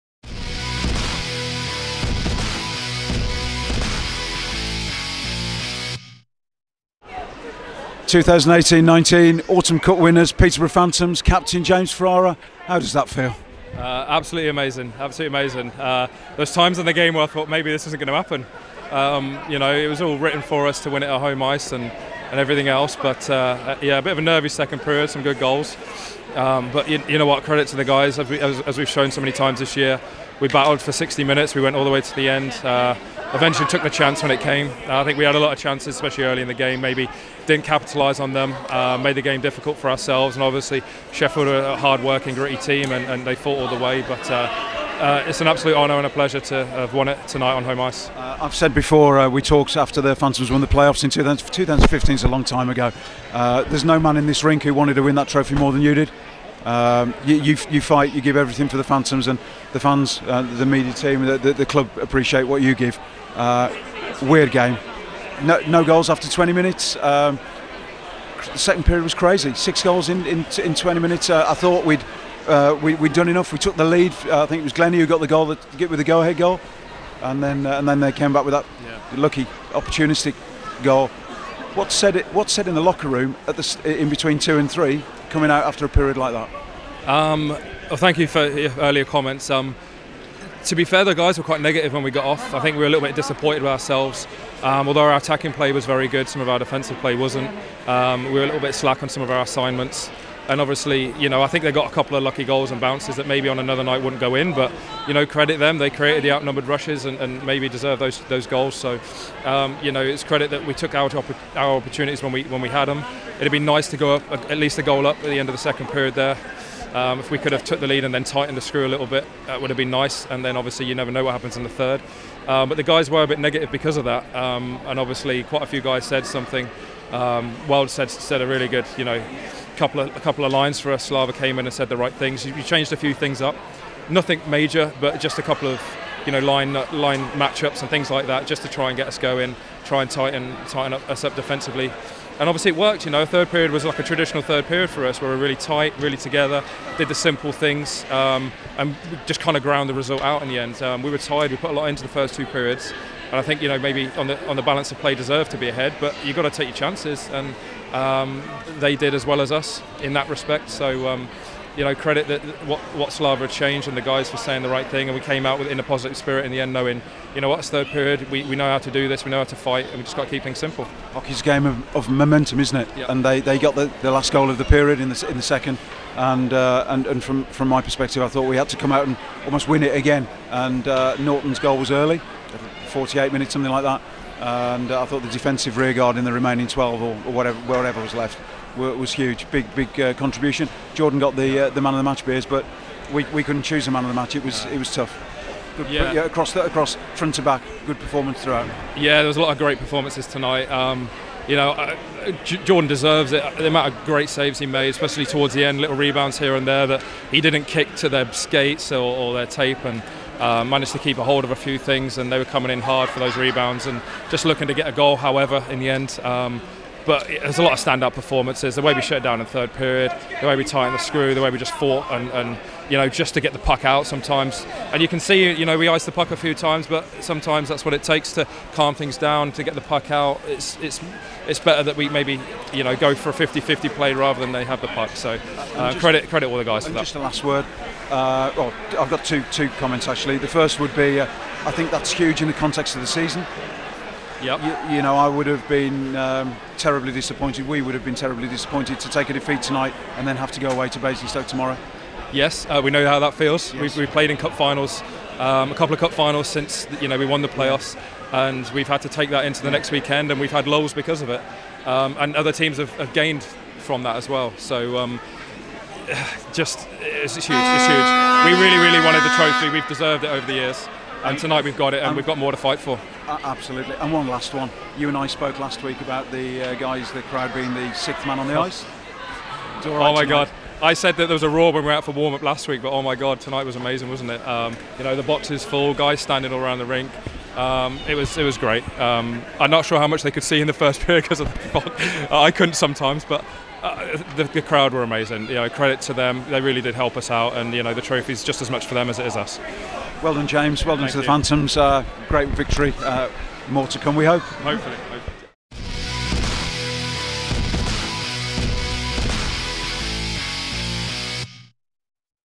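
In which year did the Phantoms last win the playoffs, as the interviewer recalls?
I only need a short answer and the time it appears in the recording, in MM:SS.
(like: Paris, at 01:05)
2015, at 00:51.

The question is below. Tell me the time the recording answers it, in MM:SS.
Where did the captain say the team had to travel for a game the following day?
04:10.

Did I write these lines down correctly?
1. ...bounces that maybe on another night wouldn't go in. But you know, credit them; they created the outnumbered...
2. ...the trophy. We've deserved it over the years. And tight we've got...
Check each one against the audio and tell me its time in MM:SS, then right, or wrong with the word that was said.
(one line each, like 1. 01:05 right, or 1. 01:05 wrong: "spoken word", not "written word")
1. 01:42 right
2. 04:29 wrong: "tonight", not "tight".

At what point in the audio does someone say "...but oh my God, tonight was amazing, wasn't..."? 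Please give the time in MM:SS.
04:42.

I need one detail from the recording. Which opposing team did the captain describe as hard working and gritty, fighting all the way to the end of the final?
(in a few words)
Sheffield.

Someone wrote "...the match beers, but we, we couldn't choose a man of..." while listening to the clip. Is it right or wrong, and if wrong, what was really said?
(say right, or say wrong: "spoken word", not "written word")
right.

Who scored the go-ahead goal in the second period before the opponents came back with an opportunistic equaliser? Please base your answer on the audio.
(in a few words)
Glennie.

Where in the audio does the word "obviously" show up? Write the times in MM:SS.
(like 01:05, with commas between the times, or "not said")
00:40, 01:40, 02:00, 02:04, 02:22.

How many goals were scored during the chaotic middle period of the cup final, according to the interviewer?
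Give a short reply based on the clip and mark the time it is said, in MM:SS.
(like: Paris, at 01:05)
6, at 01:09.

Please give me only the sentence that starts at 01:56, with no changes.
Um, if we could have took the lead and then tightened the screw a little bit, that would have been nice.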